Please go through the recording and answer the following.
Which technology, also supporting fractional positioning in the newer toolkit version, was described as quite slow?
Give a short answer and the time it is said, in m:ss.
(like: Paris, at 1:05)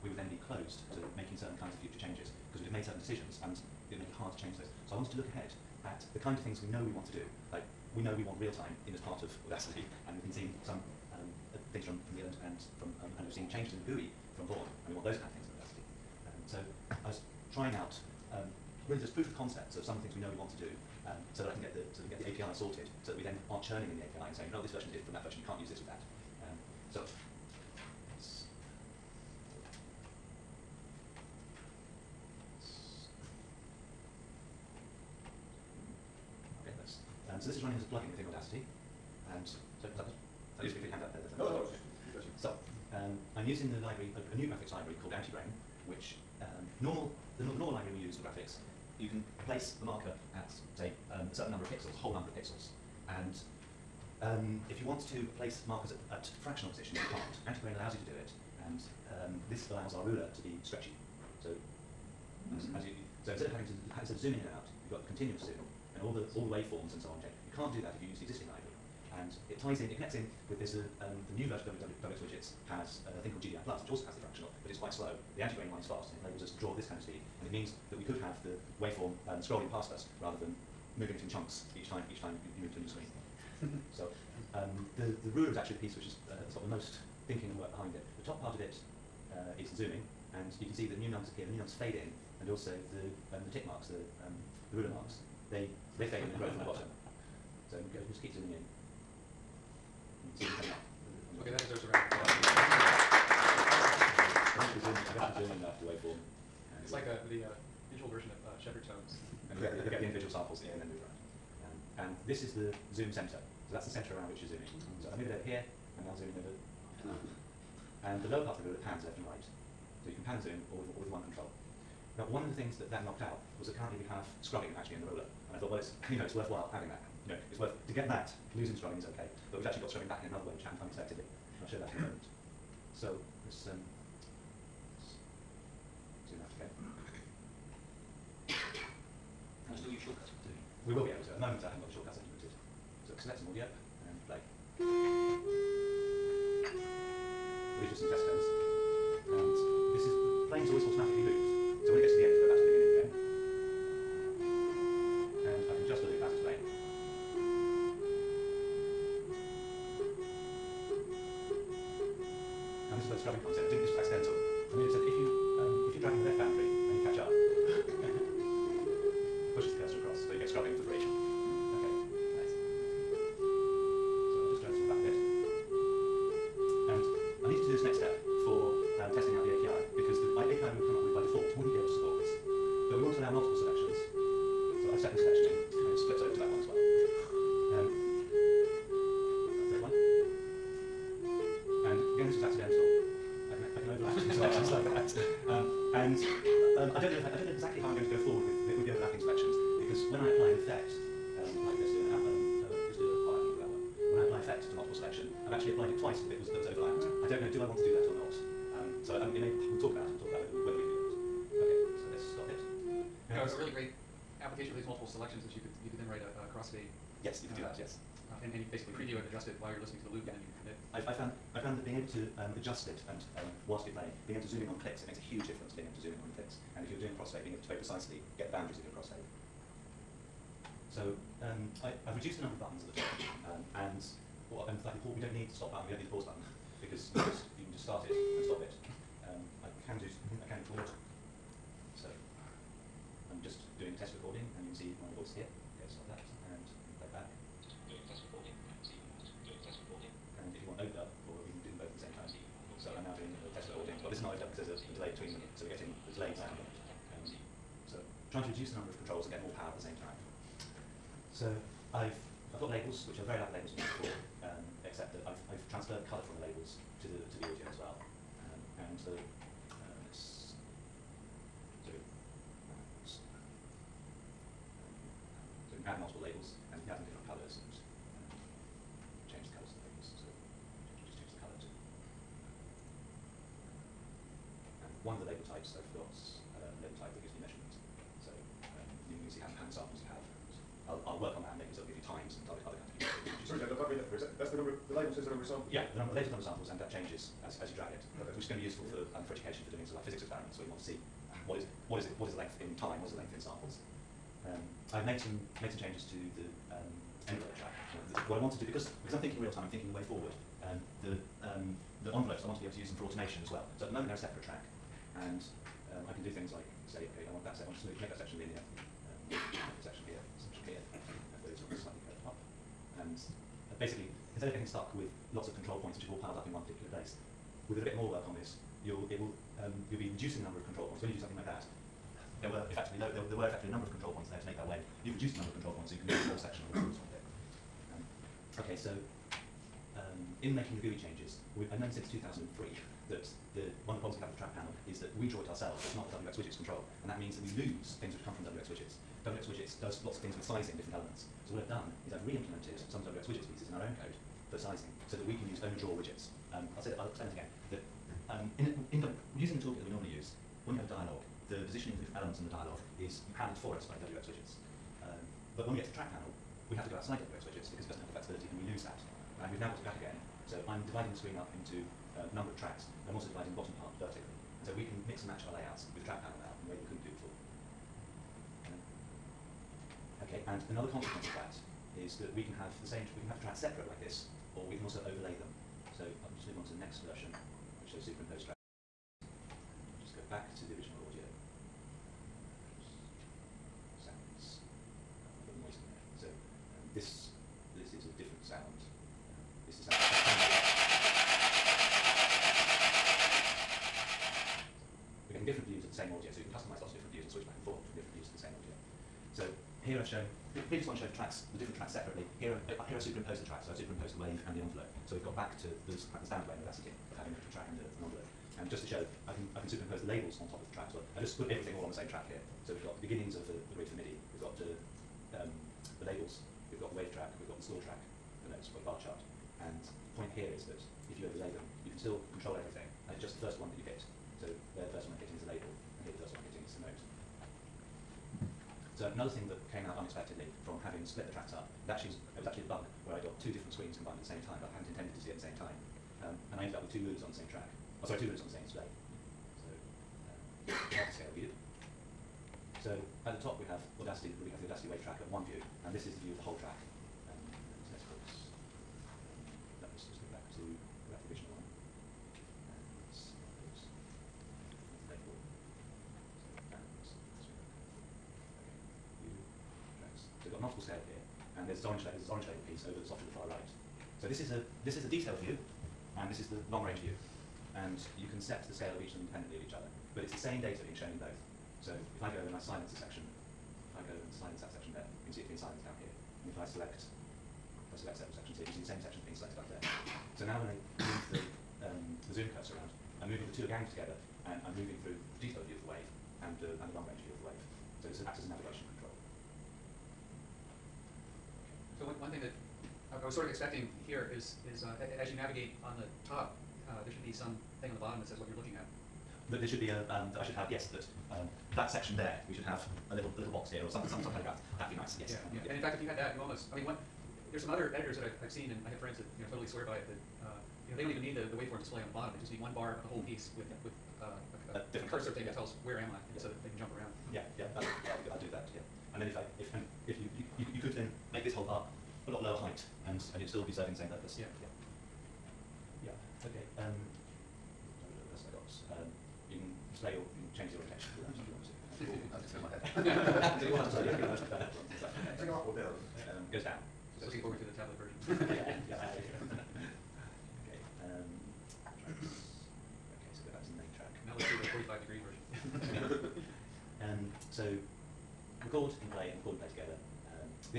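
GDI Plus, at 1:13.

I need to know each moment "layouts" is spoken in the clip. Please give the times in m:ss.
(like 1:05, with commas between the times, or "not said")
6:15.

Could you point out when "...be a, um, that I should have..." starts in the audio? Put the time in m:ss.
8:29.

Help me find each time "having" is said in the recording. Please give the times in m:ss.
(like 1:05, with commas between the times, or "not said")
1:03, 2:06, 6:57, 7:20.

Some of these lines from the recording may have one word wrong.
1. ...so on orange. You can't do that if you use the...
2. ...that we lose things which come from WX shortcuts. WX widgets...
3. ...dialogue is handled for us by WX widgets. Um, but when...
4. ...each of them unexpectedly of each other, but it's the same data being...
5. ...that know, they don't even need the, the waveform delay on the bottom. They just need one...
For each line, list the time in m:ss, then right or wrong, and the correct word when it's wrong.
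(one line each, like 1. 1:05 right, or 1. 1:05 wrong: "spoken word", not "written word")
1. 1:07 wrong: "change", not "orange"
2. 5:47 wrong: "widgets", not "shortcuts"
3. 6:02 right
4. 7:59 wrong: "independently", not "unexpectedly"
5. 8:40 wrong: "display", not "delay".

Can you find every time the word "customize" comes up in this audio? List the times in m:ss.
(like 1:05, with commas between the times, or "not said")
6:46.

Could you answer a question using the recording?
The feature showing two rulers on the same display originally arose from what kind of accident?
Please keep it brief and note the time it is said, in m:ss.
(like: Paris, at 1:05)
A bug, at 7:22.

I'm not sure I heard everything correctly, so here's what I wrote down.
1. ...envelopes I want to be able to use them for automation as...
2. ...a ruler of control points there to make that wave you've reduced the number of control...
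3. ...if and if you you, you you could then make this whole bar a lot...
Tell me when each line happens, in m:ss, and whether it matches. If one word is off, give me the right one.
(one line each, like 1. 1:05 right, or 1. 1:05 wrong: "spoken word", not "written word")
1. 5:12 right
2. 5:33 wrong: "number", not "ruler"
3. 8:49 right.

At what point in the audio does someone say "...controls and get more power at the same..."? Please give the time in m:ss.
4:19.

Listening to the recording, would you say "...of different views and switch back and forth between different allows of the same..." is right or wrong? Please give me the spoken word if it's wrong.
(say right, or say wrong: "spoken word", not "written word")
wrong: "views", not "allows".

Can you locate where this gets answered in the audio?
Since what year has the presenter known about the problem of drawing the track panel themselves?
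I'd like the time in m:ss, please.
5:42.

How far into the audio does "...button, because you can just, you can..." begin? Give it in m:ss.
3:56.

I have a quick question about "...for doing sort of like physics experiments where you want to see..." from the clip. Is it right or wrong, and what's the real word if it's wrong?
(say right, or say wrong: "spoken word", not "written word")
right.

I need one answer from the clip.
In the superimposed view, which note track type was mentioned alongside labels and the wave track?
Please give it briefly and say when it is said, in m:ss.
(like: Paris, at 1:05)
Score track, at 7:07.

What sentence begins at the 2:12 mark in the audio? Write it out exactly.
So let's, um, let's zoom out again.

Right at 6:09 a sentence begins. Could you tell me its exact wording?
And we've now got it back again.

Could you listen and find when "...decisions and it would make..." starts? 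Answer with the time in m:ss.
0:02.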